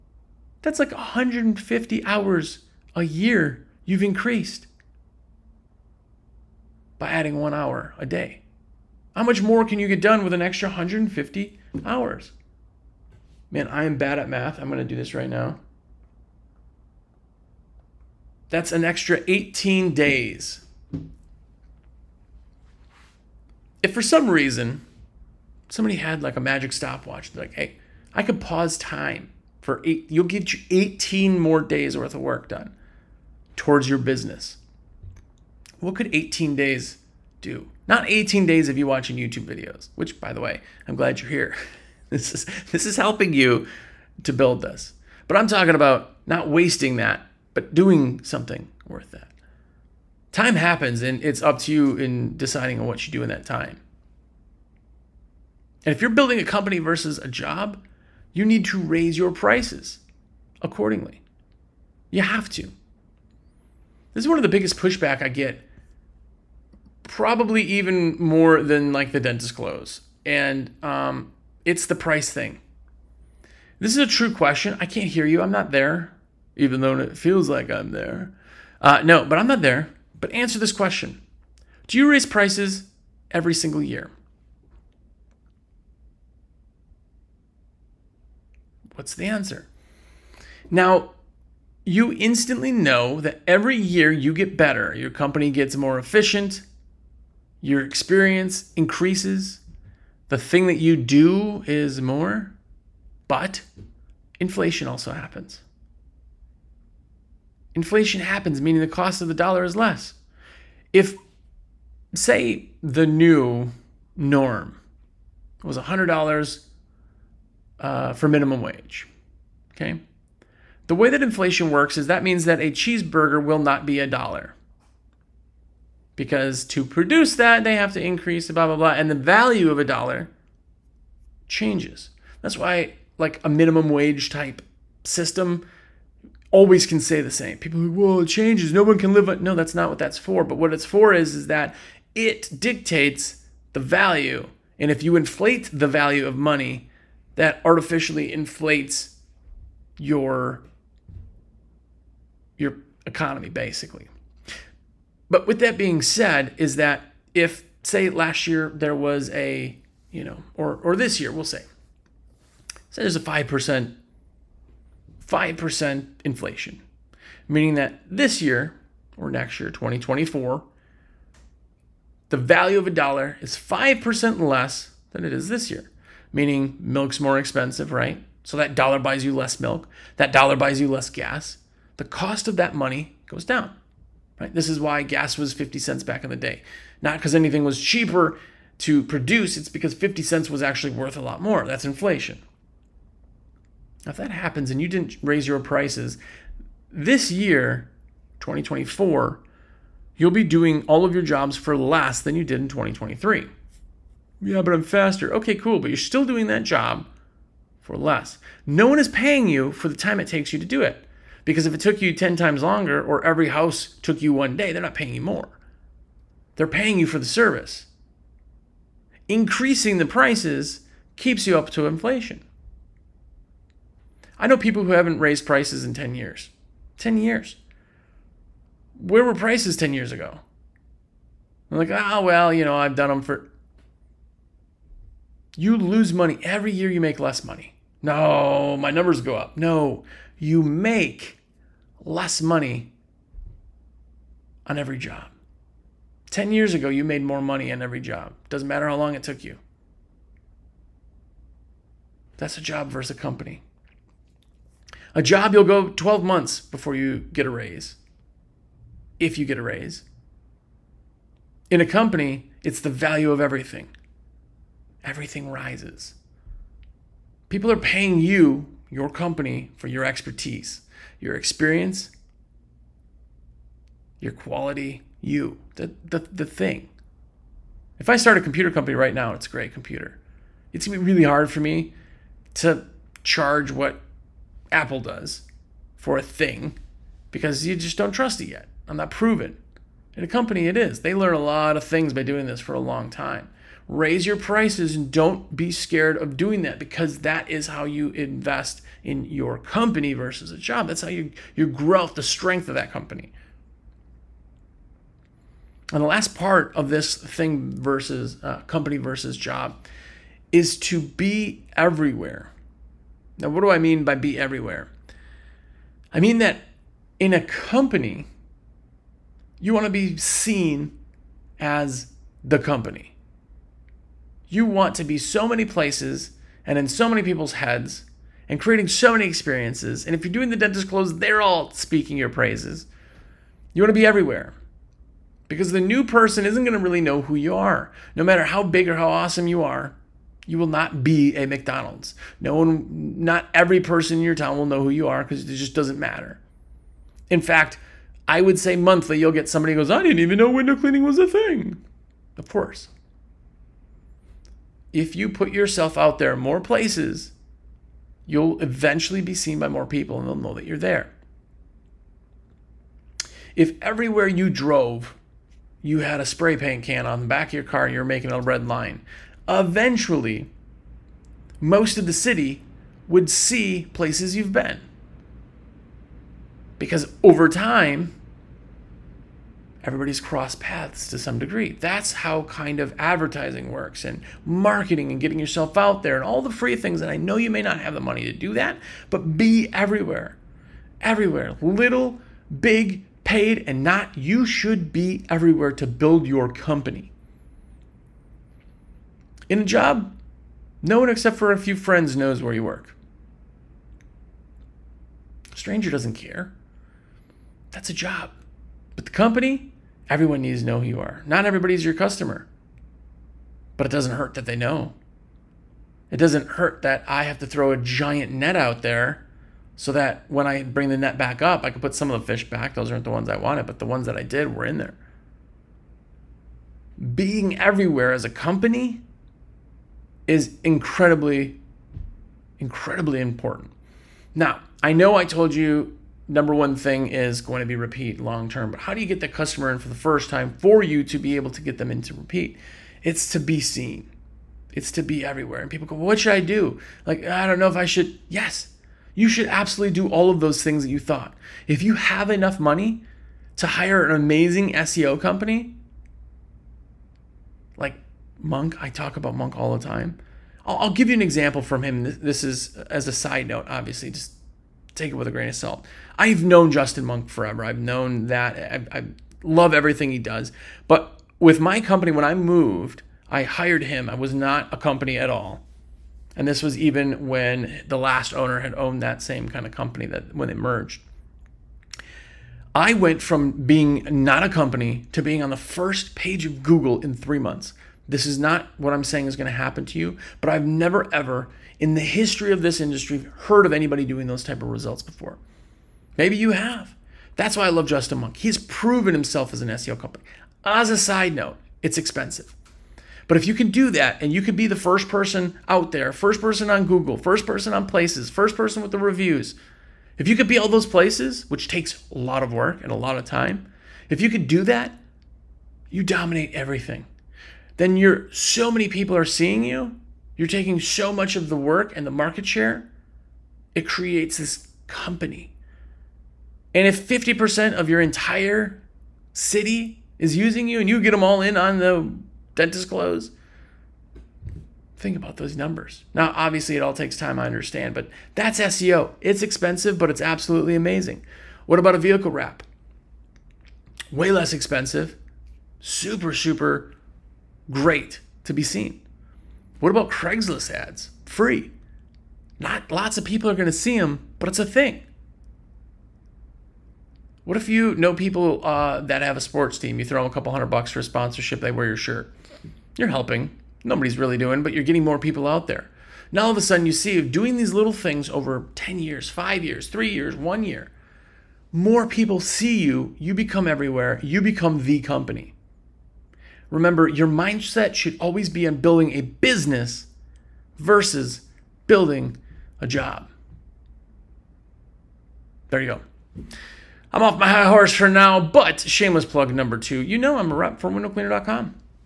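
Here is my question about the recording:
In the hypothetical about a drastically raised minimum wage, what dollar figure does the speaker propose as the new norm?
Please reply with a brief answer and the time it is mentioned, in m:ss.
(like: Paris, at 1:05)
$100, at 1:55.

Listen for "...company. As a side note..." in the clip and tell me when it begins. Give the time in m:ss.
8:19.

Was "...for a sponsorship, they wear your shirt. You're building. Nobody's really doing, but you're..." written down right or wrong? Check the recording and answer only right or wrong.
wrong.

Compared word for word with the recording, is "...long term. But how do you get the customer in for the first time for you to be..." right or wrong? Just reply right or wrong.
right.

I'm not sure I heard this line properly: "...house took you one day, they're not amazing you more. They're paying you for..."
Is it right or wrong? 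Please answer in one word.
wrong.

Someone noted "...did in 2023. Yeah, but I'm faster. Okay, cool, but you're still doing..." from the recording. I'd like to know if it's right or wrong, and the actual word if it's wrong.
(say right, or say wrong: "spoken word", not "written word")
right.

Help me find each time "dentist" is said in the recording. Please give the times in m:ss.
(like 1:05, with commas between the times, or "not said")
1:09, 5:30, 8:52.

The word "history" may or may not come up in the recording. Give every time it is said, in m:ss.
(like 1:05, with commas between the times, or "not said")
8:12.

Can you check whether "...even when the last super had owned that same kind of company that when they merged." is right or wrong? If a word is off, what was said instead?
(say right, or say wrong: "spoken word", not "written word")
wrong: "owner", not "super".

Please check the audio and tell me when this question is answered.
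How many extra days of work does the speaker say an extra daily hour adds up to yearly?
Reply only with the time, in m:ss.
0:18.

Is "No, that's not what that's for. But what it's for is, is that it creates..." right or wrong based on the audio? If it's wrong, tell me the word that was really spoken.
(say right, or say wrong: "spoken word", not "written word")
wrong: "dictates", not "creates".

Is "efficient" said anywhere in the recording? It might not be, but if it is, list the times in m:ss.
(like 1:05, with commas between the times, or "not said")
1:35.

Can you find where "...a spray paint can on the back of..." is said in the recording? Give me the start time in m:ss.
6:06.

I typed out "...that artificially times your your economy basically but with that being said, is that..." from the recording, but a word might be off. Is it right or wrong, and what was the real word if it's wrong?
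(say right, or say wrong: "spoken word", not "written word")
wrong: "inflates", not "times".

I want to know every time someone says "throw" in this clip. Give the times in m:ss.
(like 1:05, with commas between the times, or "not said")
6:57, 9:20.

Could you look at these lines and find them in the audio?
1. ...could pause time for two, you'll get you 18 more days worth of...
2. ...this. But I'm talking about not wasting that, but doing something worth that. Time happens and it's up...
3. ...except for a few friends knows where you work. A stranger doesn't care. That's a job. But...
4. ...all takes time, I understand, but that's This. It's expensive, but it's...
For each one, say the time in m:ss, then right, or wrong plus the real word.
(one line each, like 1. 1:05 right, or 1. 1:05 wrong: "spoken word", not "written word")
1. 0:28 wrong: "eight", not "two"
2. 0:44 right
3. 6:41 right
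4. 8:56 wrong: "SEO", not "This".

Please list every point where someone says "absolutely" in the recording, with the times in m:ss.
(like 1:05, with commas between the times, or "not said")
7:29, 9:00.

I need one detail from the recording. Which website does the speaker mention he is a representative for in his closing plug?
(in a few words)
windowcleaner.com.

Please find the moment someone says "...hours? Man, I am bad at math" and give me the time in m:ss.
0:11.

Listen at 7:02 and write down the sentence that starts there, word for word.
Those aren't the ones I wanted, but the ones that I did were in there.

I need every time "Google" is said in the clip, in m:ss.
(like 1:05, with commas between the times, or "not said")
8:06, 8:26.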